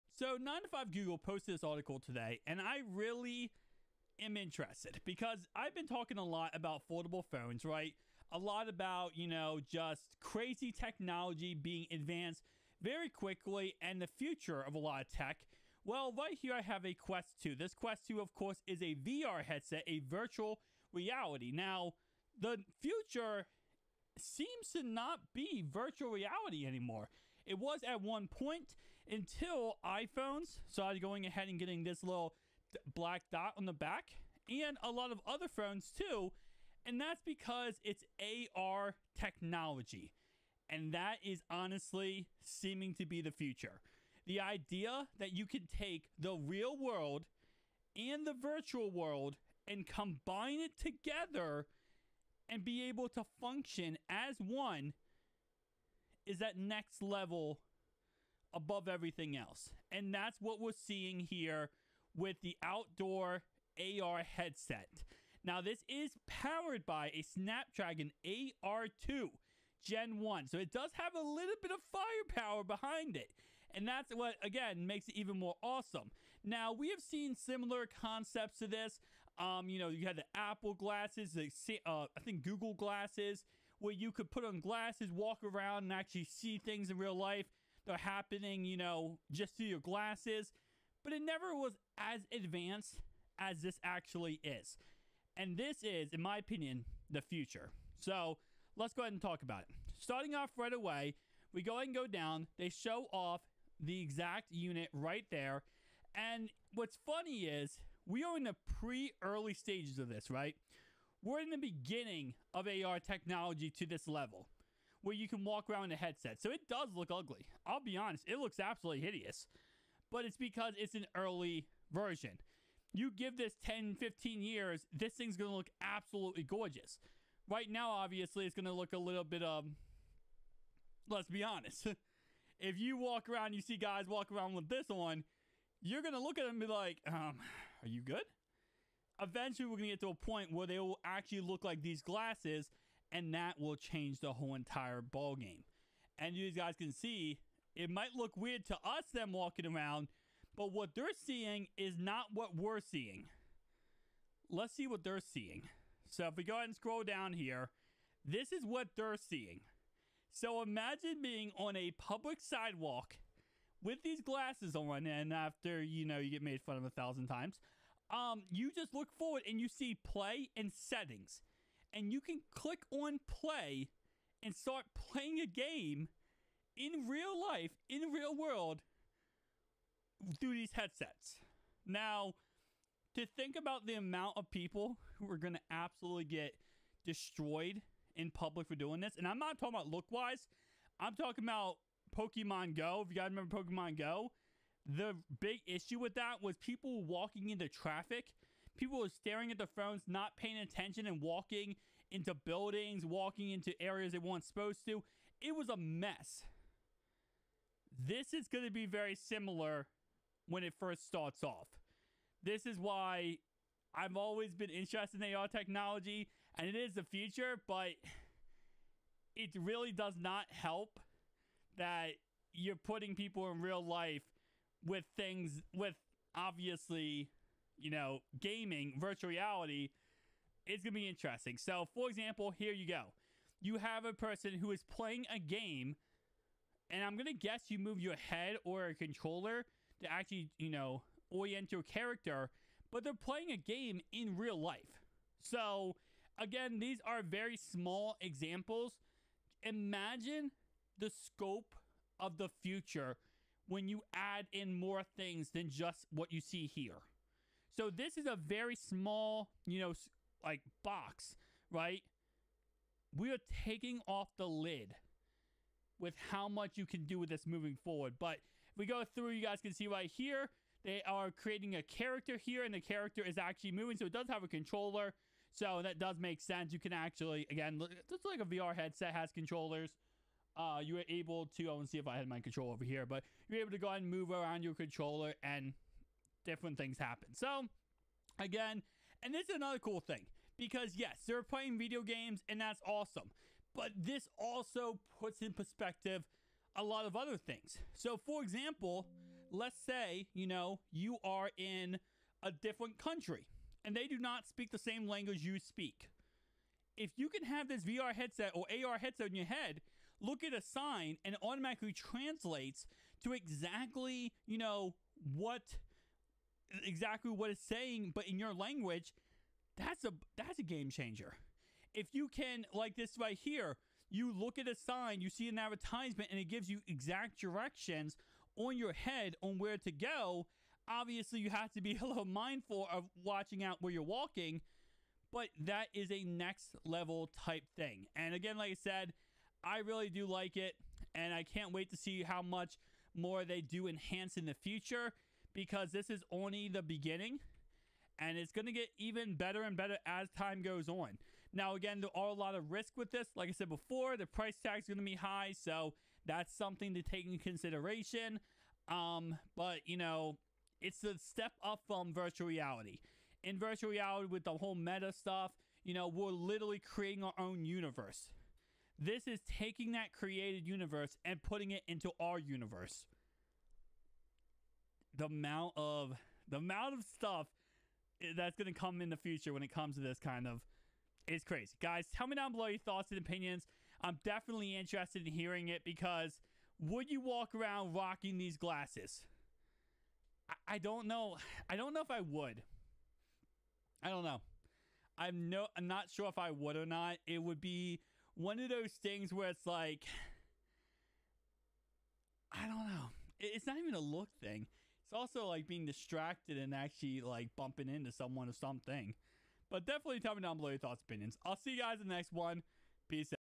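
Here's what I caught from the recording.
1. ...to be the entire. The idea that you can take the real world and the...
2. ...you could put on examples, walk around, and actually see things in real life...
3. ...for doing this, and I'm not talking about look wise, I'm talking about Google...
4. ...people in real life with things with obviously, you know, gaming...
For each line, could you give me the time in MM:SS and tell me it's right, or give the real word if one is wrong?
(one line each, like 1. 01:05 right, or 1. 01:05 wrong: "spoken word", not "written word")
1. 00:42 wrong: "future", not "entire"
2. 01:23 wrong: "glasses", not "examples"
3. 03:08 wrong: "Pokemon", not "Google"
4. 03:43 right.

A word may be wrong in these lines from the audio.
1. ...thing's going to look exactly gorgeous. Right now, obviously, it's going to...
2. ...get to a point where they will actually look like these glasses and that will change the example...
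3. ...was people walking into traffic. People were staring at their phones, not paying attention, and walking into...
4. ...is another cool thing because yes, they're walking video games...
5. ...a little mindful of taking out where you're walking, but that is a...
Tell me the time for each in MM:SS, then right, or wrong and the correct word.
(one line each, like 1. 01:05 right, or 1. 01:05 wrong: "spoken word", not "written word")
1. 02:05 wrong: "absolutely", not "exactly"
2. 02:19 wrong: "whole", not "example"
3. 03:16 right
4. 04:49 wrong: "playing", not "walking"
5. 05:32 wrong: "watching", not "taking".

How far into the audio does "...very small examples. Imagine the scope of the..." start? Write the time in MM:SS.
04:07.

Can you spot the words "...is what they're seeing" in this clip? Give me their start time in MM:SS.
02:38.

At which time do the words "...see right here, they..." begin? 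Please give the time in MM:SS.
04:29.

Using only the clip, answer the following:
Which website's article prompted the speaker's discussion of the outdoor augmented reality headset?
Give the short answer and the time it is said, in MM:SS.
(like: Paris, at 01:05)
9to5Google, at 00:00.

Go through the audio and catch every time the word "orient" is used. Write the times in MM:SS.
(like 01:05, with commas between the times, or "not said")
04:01.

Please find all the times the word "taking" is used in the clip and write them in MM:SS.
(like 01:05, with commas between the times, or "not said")
04:23, 06:09.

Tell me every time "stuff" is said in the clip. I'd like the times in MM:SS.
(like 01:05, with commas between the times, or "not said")
06:05, 06:17.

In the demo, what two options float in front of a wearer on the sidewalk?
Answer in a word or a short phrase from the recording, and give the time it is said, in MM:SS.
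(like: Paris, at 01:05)
Play and settings, at 02:50.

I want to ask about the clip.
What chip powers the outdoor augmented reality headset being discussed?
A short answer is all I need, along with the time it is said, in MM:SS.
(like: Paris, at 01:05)
Snapdragon AR2 Gen 1, at 01:07.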